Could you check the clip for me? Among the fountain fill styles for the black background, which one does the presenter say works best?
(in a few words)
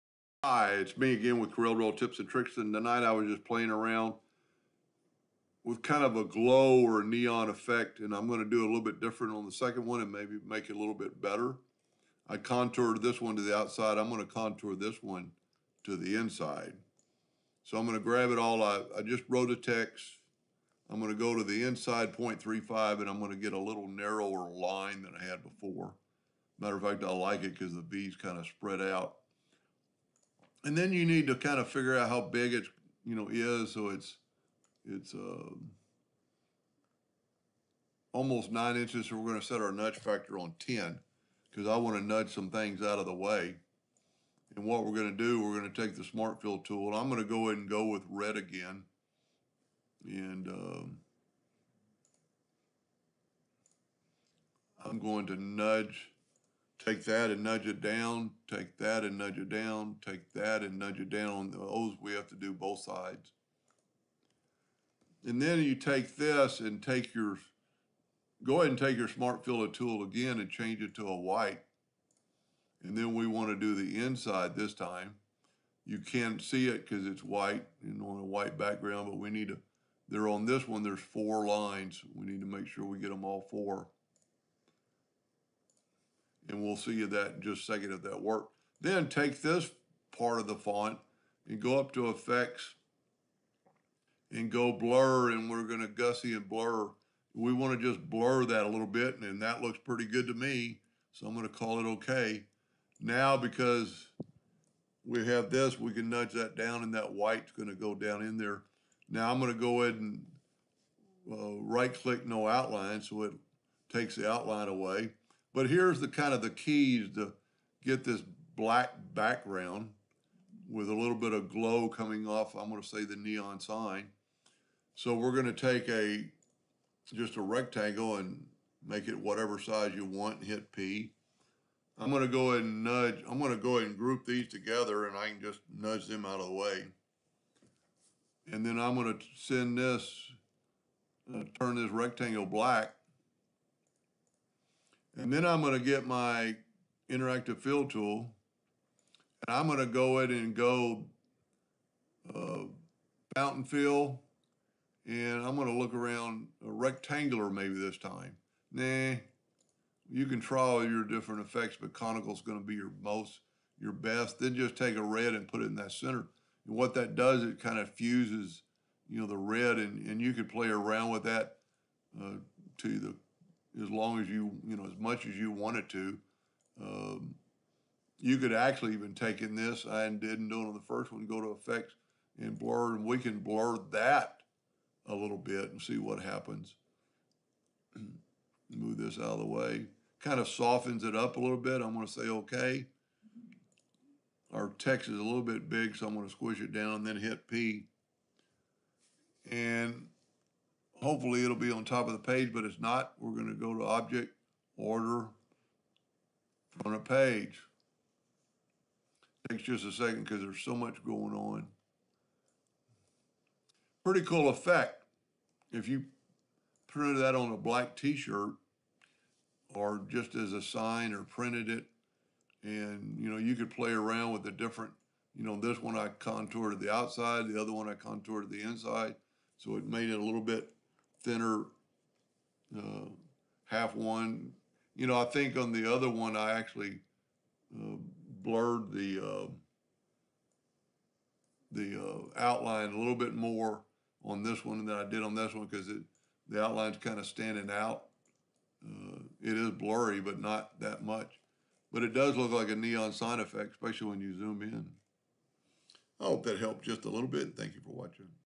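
Conical.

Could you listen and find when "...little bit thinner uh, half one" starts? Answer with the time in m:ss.
3:50.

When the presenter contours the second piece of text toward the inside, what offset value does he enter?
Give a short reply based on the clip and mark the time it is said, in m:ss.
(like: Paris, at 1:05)
0.35, at 0:22.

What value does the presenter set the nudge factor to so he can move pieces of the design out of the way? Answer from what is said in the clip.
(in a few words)
10.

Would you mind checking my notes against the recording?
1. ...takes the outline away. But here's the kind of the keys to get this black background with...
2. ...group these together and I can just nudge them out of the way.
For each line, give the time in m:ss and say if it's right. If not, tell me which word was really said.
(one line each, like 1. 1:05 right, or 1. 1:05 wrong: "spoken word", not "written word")
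1. 1:53 right
2. 2:13 right.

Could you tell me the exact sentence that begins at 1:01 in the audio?
Those we have to do both sides.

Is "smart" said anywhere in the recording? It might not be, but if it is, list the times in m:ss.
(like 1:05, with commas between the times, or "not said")
0:46, 1:09.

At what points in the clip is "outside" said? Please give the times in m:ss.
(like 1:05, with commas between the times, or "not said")
0:13, 3:46.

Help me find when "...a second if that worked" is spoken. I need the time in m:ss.
1:27.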